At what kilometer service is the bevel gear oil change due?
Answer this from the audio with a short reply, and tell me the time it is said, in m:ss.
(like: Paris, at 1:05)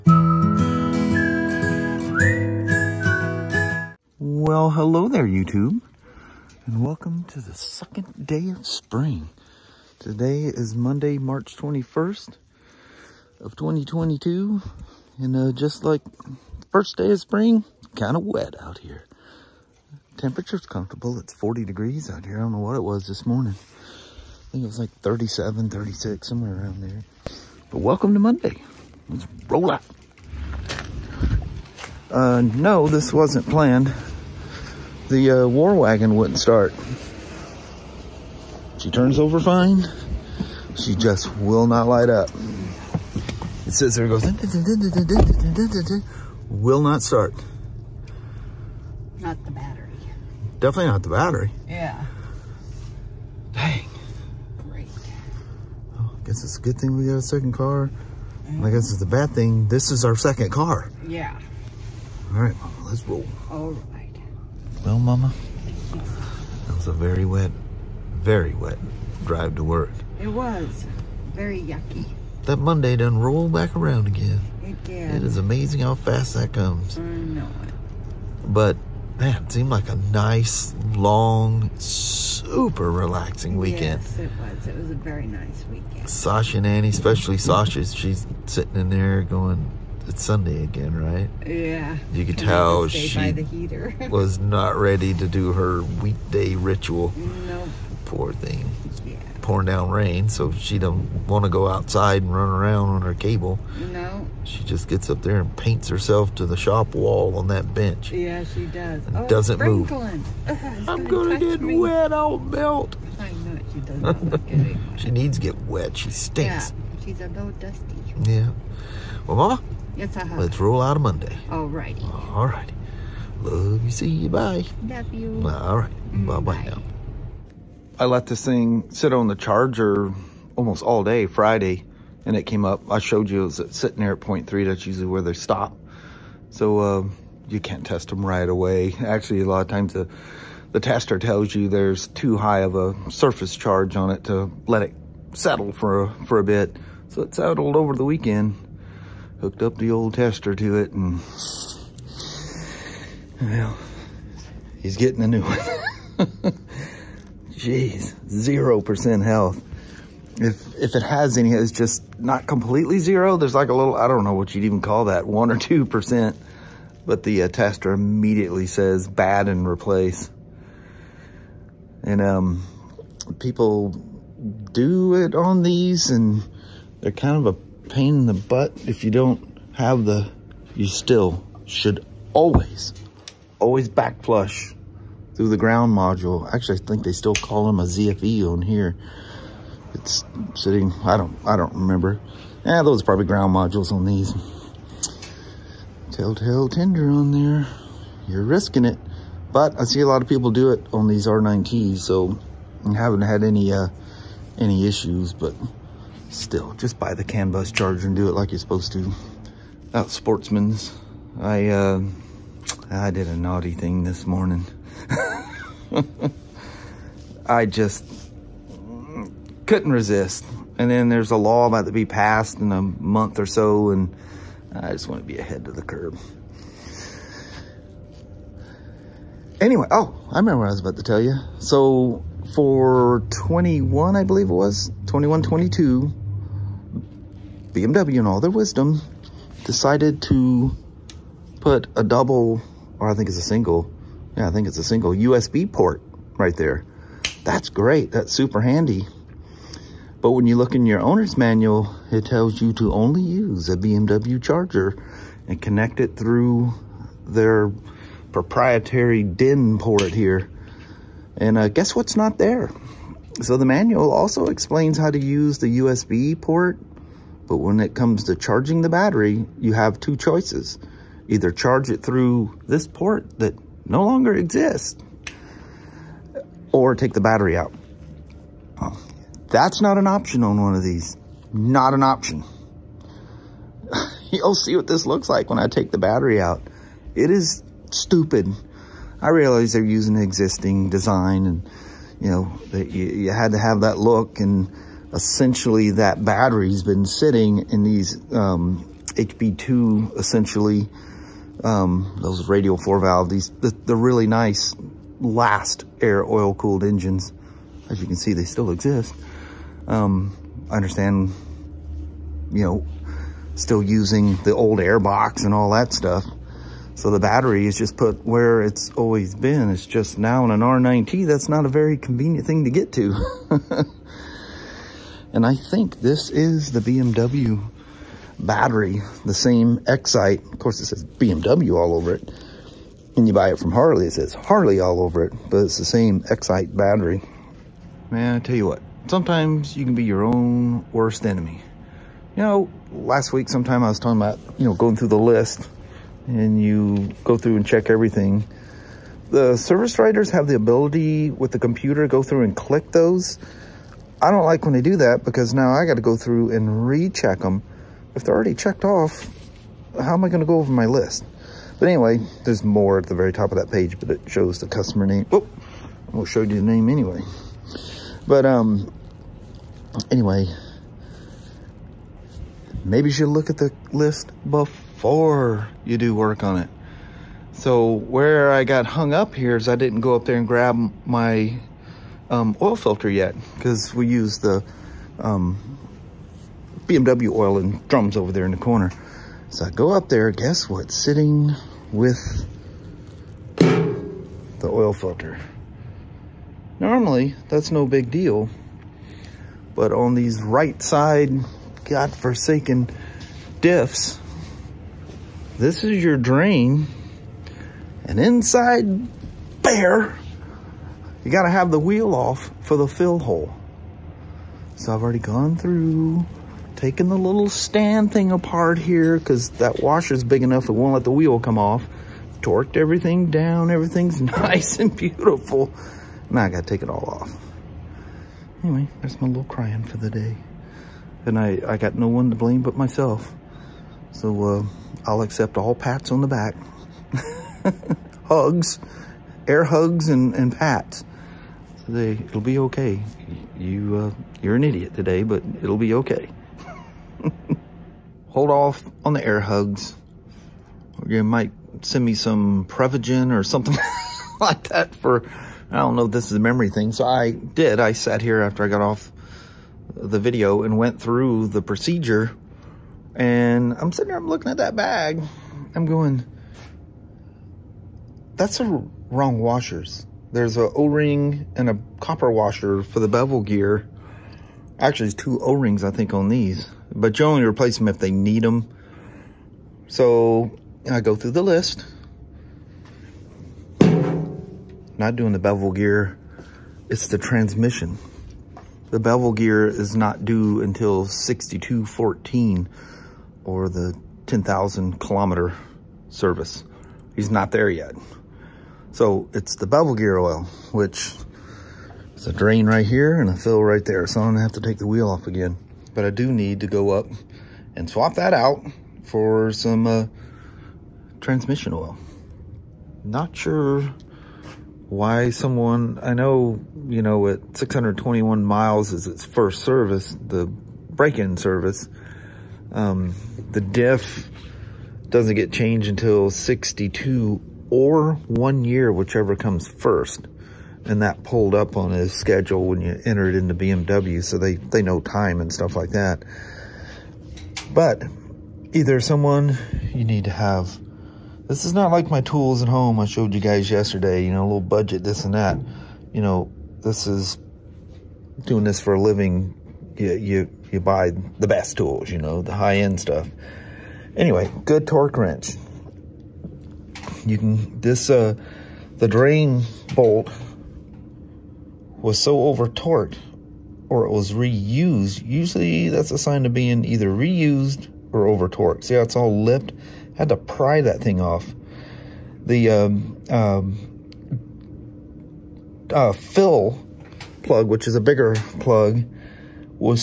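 10,000 kilometer, at 8:14.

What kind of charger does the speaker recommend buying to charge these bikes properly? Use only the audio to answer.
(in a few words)
CAN bus charger.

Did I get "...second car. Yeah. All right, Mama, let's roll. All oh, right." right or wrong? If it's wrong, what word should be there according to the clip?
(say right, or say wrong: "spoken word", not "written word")
right.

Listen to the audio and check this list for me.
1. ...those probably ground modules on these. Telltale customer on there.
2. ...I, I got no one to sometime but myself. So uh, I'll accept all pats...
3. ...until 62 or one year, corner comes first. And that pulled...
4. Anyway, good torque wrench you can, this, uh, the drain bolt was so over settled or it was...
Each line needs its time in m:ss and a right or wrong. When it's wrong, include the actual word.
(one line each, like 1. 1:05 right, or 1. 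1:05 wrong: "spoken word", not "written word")
1. 3:12 wrong: "tender", not "customer"
2. 7:11 wrong: "blame", not "sometime"
3. 8:45 wrong: "whichever", not "corner"
4. 9:14 wrong: "torqued", not "settled".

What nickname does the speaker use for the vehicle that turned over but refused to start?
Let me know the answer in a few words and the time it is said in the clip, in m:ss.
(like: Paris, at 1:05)
war wagon, at 0:35.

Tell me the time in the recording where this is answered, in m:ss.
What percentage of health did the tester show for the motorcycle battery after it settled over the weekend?
2:38.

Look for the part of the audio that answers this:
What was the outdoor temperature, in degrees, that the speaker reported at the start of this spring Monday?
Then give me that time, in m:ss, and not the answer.
0:21.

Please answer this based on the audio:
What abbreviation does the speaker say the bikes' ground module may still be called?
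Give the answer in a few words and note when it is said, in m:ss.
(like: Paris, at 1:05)
ZFE, at 3:07.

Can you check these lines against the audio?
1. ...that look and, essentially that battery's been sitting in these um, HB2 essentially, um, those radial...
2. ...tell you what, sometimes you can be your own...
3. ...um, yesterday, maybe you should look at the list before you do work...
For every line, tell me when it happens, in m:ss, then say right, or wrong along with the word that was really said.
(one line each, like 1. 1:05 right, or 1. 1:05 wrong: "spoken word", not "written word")
1. 4:53 right
2. 5:38 right
3. 6:08 wrong: "anyway", not "yesterday".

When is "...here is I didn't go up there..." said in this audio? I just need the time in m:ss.
6:19.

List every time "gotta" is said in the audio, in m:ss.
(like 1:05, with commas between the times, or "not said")
6:51, 7:06.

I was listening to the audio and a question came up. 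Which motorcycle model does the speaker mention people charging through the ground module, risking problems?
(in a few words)
R9T.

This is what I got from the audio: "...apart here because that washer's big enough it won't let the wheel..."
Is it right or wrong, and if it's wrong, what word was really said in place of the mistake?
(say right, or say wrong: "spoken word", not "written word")
right.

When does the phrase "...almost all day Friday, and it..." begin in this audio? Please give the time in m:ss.
2:10.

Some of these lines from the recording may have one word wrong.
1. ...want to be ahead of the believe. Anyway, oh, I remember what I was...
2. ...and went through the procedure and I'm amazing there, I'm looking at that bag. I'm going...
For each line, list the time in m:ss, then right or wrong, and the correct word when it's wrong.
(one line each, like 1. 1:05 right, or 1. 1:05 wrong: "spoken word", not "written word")
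1. 3:45 wrong: "curve", not "believe"
2. 7:40 wrong: "sitting", not "amazing".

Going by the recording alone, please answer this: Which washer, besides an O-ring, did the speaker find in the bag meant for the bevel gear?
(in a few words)
copper washer.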